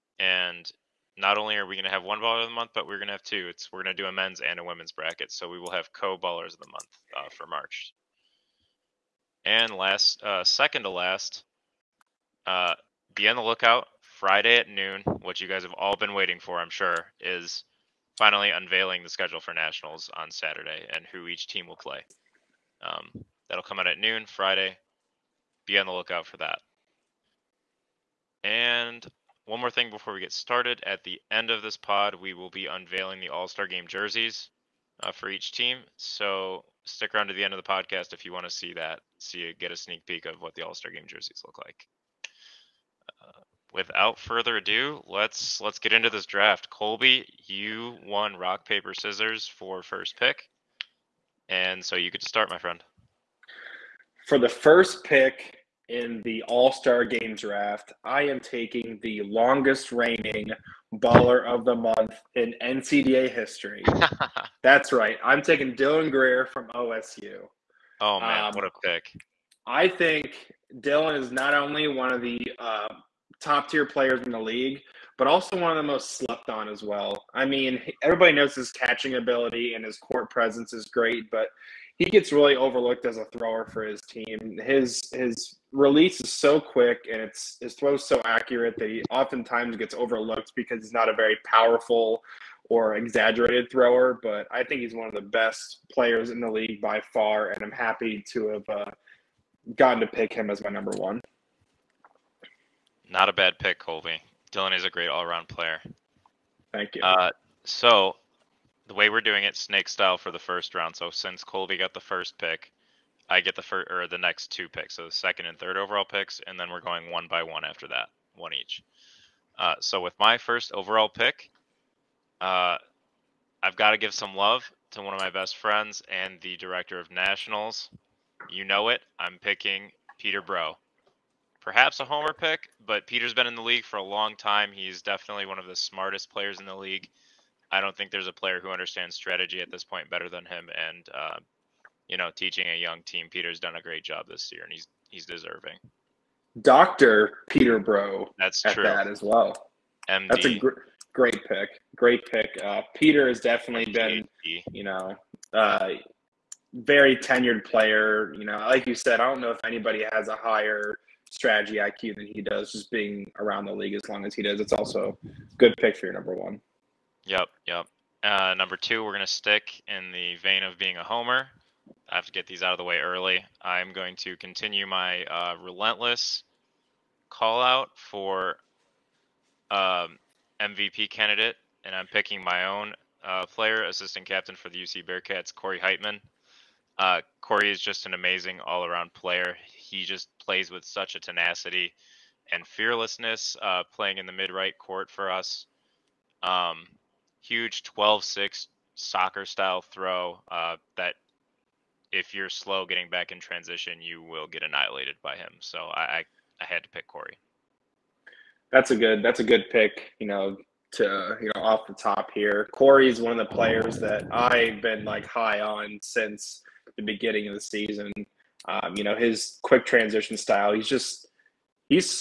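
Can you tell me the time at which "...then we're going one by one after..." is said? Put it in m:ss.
1:56.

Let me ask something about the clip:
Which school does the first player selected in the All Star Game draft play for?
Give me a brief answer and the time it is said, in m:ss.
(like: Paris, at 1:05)
OSU, at 1:06.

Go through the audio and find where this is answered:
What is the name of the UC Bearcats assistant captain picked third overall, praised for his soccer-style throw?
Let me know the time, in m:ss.
3:05.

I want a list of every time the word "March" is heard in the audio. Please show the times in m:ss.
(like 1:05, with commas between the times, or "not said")
0:07.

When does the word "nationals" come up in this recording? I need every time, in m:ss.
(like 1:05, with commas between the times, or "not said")
0:19, 2:07.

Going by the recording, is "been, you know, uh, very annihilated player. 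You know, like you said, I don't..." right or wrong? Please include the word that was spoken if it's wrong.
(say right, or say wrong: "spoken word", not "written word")
wrong: "tenured", not "annihilated".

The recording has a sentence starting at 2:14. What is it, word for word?
He's definitely one of the smartest players in the league.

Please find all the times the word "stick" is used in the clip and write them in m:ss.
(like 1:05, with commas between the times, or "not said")
0:36, 2:49.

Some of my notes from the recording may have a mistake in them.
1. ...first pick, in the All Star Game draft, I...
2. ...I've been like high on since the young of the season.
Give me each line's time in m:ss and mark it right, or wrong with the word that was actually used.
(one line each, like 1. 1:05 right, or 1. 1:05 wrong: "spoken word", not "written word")
1. 0:54 right
2. 3:34 wrong: "beginning", not "young".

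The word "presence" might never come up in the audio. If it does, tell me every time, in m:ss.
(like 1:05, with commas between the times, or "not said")
1:20.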